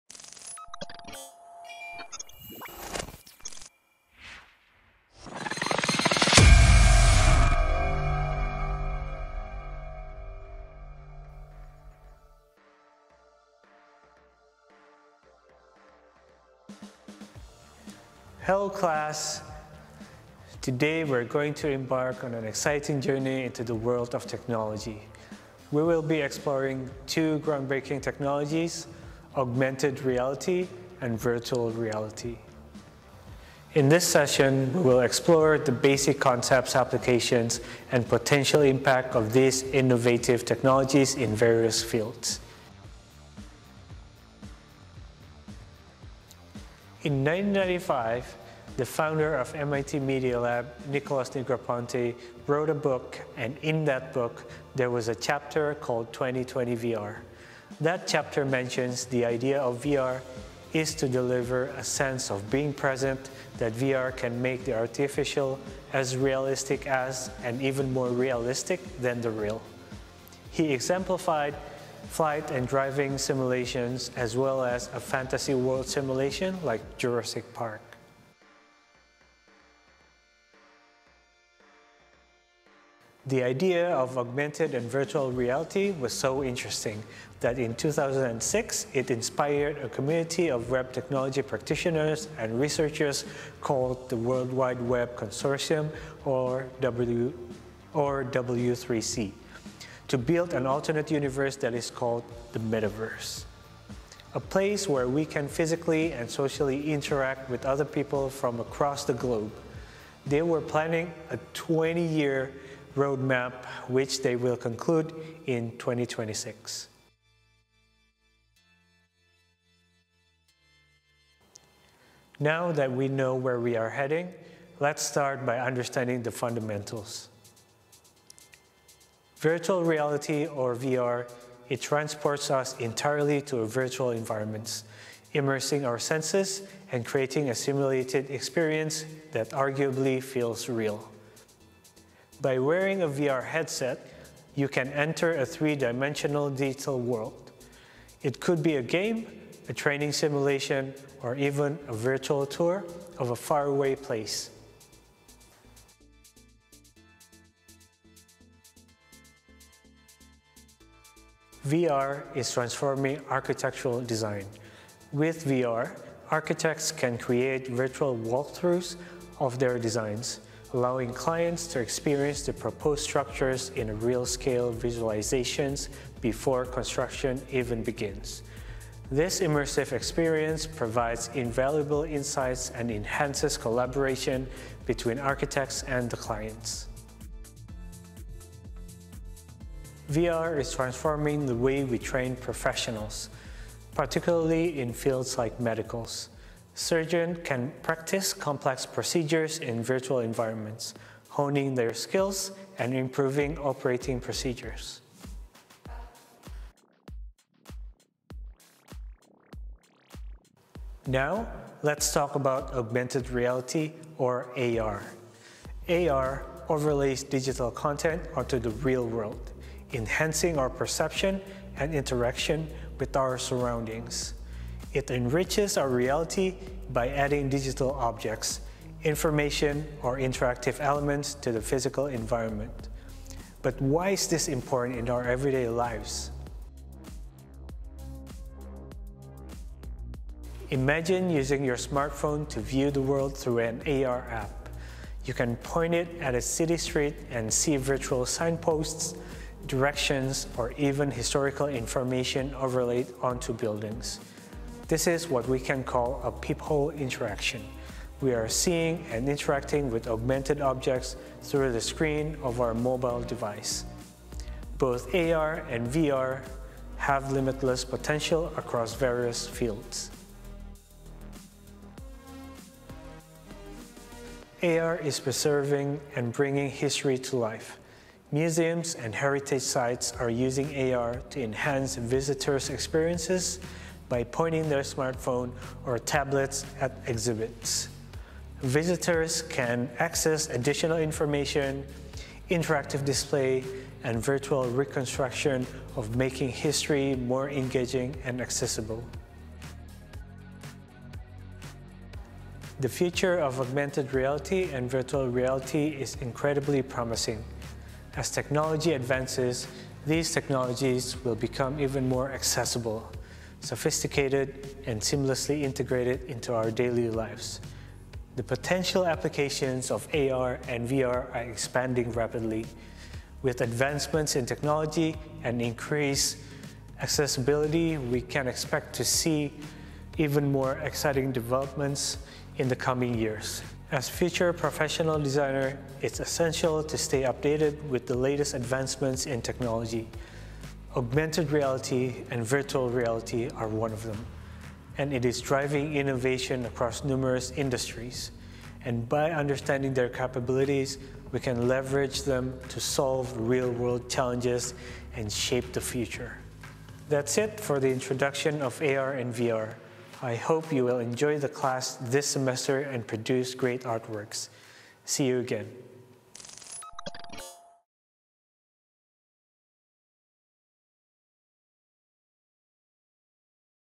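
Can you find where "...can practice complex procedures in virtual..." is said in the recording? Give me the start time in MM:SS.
03:17.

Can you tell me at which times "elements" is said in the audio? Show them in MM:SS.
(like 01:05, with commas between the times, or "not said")
03:50.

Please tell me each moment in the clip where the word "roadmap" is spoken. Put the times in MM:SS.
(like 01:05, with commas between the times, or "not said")
01:52.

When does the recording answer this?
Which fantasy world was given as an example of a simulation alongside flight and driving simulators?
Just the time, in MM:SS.
01:16.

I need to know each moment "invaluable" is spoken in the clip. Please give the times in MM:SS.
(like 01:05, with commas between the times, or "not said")
03:01.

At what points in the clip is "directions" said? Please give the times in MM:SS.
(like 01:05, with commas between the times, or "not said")
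04:09.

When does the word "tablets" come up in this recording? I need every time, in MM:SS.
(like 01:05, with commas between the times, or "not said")
04:45.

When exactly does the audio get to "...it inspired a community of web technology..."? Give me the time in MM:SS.
01:28.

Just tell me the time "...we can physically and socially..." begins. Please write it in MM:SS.
01:45.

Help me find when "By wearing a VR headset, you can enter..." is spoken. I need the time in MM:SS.
02:22.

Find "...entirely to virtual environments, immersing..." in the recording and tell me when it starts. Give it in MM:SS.
02:12.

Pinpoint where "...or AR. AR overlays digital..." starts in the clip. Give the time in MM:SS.
03:34.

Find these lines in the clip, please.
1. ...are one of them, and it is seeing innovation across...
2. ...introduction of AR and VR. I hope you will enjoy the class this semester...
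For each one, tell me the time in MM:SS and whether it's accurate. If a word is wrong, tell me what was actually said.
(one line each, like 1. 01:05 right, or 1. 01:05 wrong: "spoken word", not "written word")
1. 05:43 wrong: "driving", not "seeing"
2. 05:57 right.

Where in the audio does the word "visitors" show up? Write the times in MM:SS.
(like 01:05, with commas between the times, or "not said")
04:41, 04:48.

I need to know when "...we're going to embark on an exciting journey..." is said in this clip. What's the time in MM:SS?
00:21.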